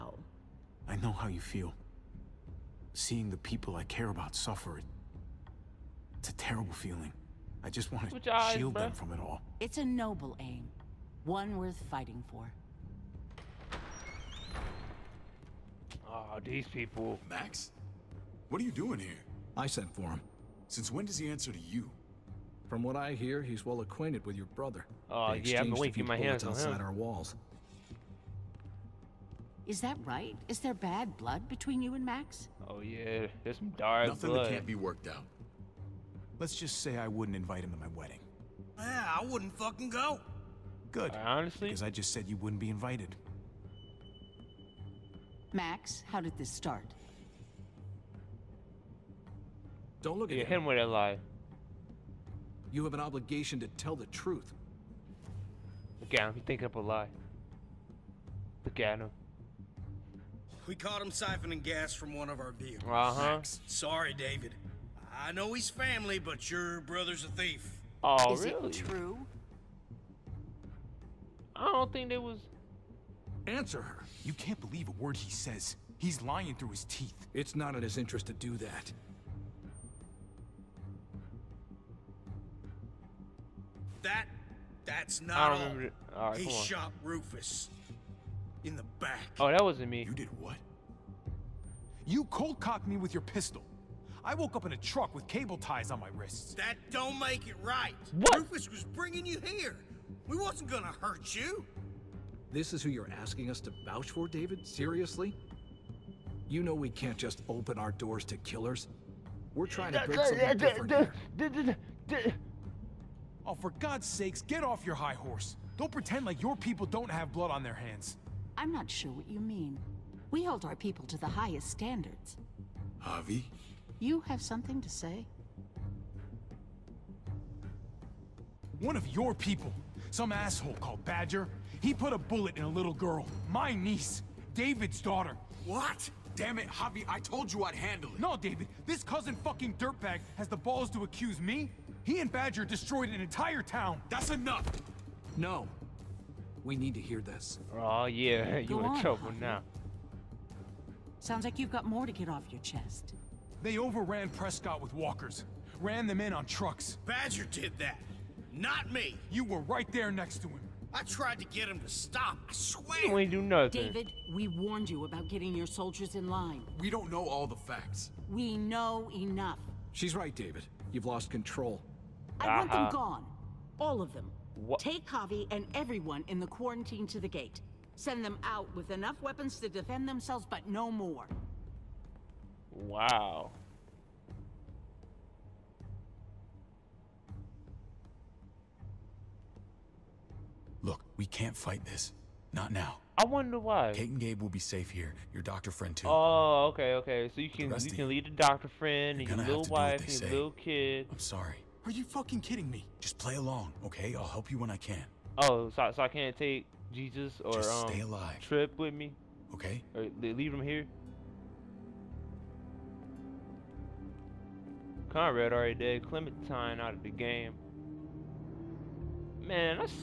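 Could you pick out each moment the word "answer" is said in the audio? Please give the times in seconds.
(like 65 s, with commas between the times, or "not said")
21 s, 73 s.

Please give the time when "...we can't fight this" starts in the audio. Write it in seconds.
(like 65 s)
191 s.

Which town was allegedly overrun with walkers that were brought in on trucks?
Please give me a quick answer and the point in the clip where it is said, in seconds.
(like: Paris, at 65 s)
Prescott, at 154 s.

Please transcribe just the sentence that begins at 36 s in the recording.
Let's just say I wouldn't invite him to my wedding.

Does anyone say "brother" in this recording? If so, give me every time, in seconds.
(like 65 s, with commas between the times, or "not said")
24 s, 66 s.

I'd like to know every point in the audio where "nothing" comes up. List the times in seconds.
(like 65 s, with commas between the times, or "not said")
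34 s, 163 s.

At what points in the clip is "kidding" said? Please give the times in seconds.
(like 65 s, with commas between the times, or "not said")
202 s.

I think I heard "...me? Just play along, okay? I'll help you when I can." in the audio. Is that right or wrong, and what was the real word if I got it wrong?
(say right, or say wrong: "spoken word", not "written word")
right.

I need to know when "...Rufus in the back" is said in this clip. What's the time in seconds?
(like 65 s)
87 s.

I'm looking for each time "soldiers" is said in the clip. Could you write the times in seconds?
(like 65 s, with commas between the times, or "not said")
165 s.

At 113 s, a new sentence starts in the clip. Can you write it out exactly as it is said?
Oh, for God's sakes, get off your high horse.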